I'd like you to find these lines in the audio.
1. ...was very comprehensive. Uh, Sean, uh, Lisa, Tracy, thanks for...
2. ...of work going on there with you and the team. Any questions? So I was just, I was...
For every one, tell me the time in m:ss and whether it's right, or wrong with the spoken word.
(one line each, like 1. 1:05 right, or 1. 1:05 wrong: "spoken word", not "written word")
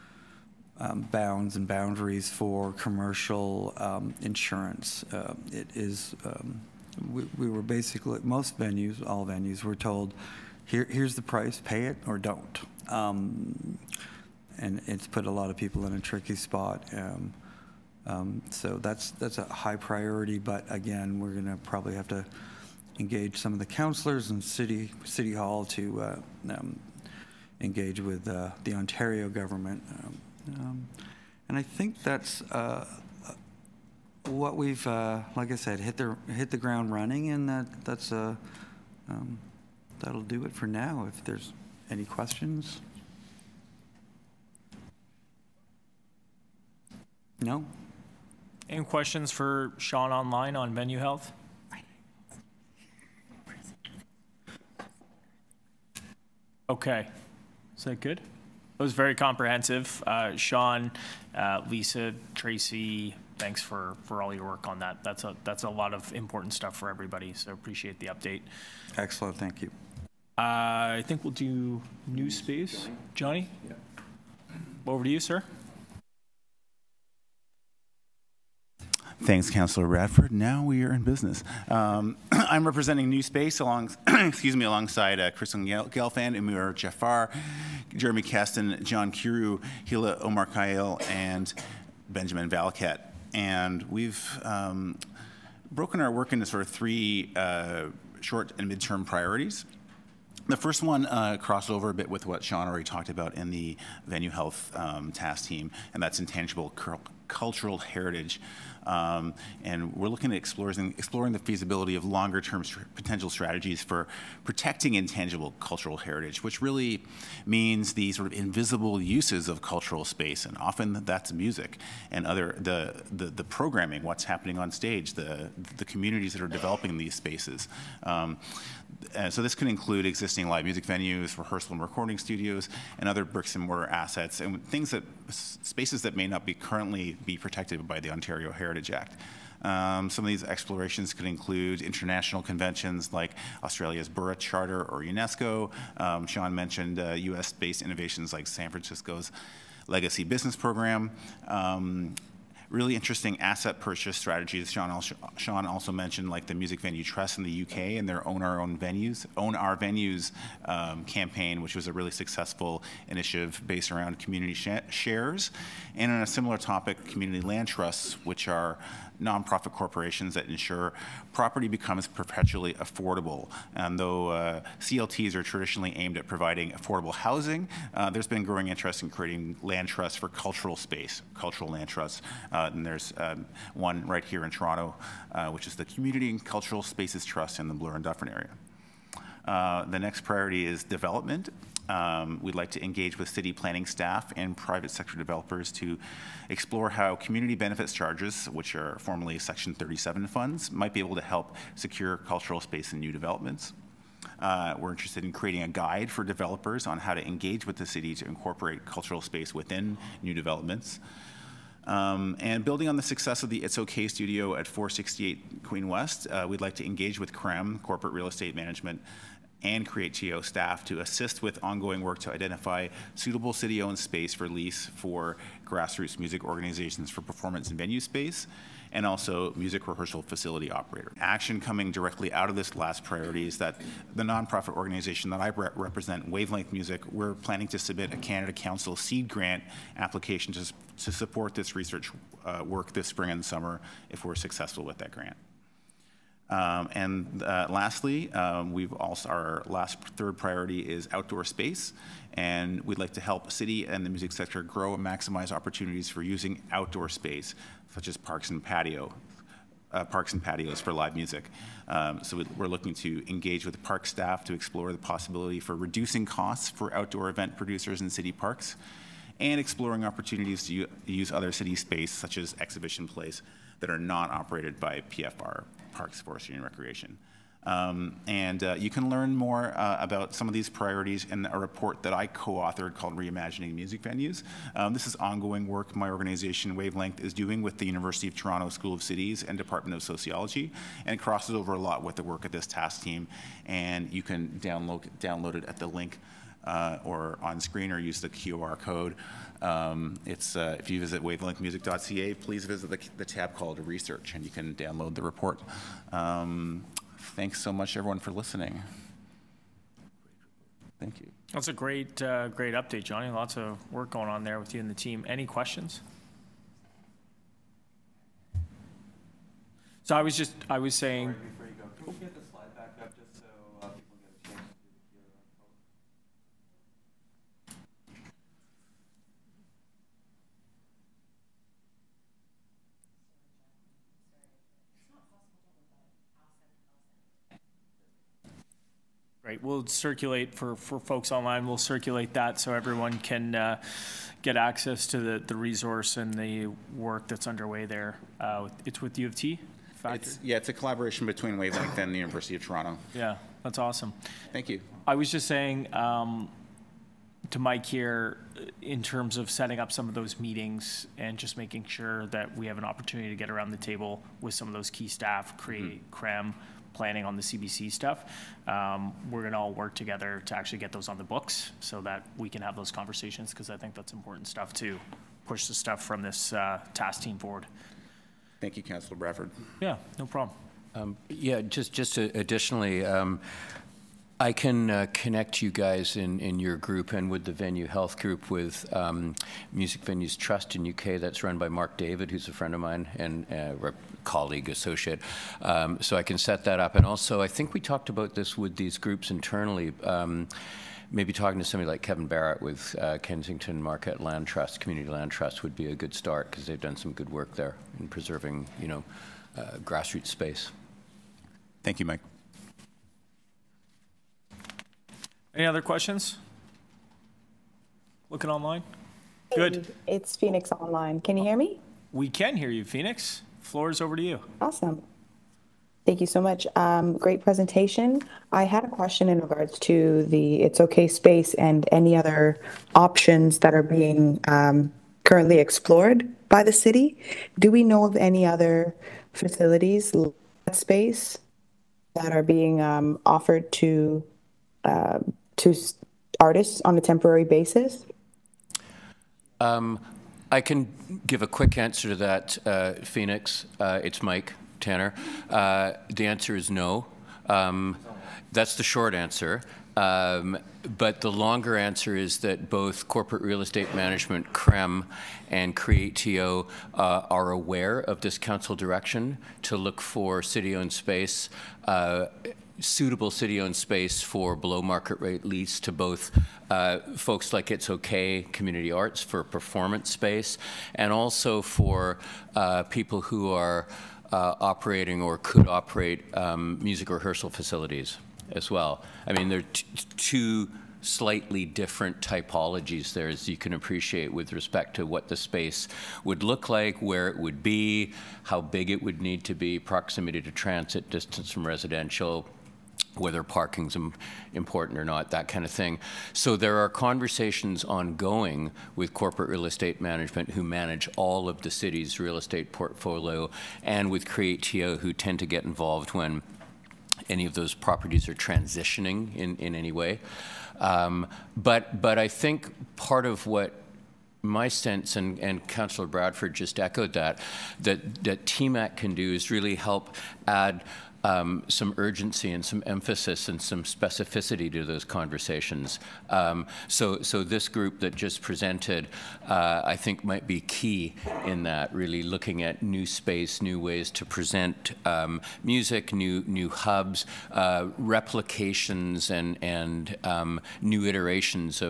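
1. 0:58 right
2. 5:13 right.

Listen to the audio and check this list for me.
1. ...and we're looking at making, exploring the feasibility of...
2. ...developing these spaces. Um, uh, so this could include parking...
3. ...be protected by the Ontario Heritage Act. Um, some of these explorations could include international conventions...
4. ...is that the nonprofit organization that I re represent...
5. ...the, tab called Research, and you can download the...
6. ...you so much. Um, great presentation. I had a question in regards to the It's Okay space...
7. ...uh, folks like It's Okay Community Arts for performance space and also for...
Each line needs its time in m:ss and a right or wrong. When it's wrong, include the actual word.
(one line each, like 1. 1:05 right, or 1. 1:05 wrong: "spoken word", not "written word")
1. 1:49 wrong: "exploring", not "making"
2. 2:06 wrong: "existing", not "parking"
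3. 2:17 right
4. 3:53 right
5. 5:03 right
6. 7:06 right
7. 7:56 right.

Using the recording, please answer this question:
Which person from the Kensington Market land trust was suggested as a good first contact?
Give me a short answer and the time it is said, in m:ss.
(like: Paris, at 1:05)
Kevin Barrett, at 6:42.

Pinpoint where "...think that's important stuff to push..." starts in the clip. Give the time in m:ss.
6:13.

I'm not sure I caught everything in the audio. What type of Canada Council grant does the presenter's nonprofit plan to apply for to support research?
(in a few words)
seed grant.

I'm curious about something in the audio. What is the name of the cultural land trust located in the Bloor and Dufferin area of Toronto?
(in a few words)
Community and Cultural Spaces Trust.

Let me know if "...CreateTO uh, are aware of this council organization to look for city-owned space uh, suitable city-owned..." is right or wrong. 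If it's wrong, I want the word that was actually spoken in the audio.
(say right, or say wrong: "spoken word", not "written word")
wrong: "direction", not "organization".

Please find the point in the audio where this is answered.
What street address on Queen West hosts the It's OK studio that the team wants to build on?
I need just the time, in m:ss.
3:34.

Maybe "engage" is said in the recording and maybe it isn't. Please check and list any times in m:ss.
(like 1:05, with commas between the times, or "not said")
0:22, 0:27, 3:12, 3:27, 3:36, 4:23.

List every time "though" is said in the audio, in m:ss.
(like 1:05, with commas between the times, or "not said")
2:53.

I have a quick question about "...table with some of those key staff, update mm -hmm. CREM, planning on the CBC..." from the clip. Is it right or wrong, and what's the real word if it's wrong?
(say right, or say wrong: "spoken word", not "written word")
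wrong: "create", not "update".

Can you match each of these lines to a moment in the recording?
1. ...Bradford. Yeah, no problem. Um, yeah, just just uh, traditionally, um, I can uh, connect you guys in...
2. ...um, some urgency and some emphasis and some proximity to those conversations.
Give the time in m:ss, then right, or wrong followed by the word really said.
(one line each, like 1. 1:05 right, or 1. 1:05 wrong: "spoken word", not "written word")
1. 6:19 wrong: "additionally", not "traditionally"
2. 8:51 wrong: "specificity", not "proximity".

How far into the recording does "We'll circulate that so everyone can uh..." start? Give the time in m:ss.
5:41.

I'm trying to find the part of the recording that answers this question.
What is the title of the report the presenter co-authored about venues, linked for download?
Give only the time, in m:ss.
4:43.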